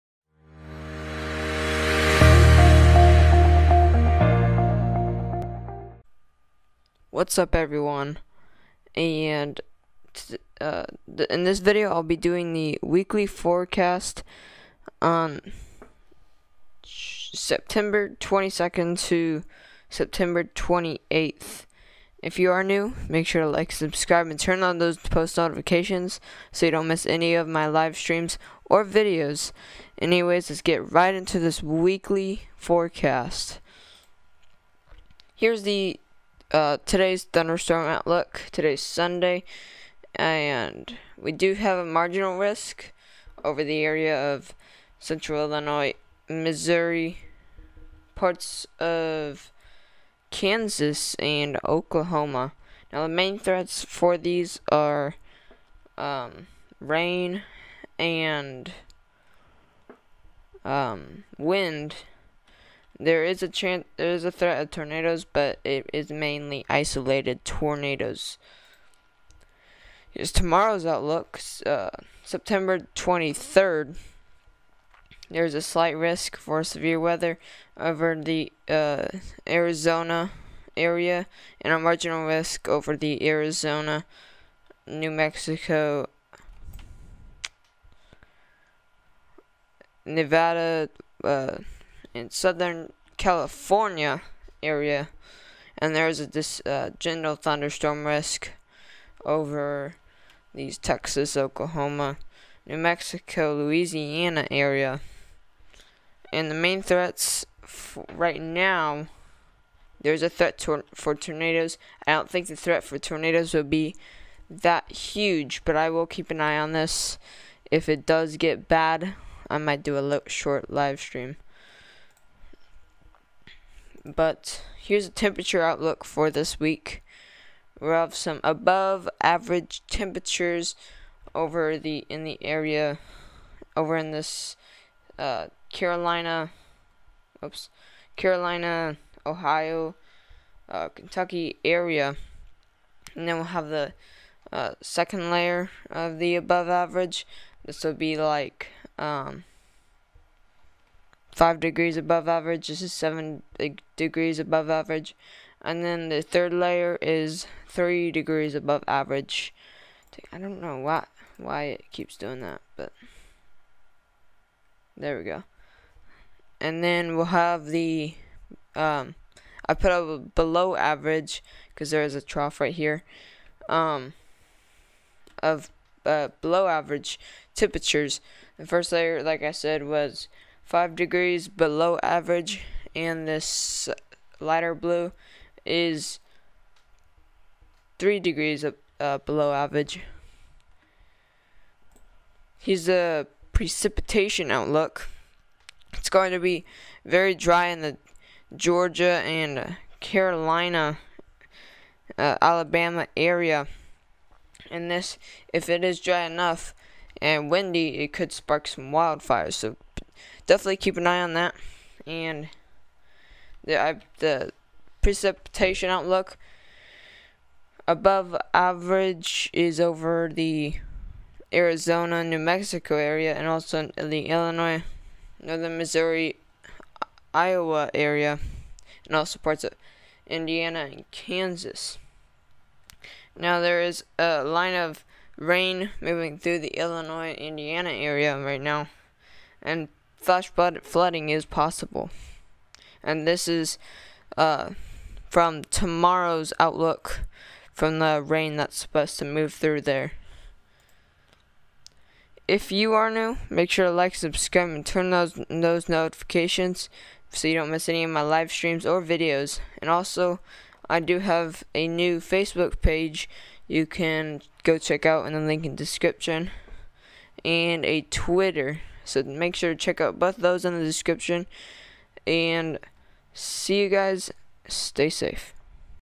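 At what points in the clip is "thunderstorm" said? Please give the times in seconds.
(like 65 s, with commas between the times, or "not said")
37 s, 97 s.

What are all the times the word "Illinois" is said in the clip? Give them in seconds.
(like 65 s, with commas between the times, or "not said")
45 s, 224 s, 236 s.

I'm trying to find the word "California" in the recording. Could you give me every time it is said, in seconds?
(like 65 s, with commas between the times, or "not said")
93 s.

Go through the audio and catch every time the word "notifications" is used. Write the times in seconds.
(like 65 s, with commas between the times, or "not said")
25 s, 255 s.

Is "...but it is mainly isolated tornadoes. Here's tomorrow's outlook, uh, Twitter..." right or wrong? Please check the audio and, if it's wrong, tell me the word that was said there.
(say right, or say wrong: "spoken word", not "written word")
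wrong: "September", not "Twitter".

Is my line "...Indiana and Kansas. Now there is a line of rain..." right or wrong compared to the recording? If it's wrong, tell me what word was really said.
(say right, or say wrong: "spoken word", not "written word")
right.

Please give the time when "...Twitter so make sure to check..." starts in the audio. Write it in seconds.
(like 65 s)
268 s.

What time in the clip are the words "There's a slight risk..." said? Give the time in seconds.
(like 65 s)
75 s.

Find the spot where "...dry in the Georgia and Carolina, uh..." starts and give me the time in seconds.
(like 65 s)
197 s.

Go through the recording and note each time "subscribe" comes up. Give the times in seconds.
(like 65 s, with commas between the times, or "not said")
23 s, 254 s.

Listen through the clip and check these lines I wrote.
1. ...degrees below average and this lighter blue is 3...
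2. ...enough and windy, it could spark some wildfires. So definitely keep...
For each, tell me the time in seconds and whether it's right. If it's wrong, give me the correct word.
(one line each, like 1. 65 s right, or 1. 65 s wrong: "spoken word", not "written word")
1. 180 s right
2. 206 s right.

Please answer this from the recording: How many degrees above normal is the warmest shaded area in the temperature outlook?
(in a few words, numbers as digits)
7 degrees.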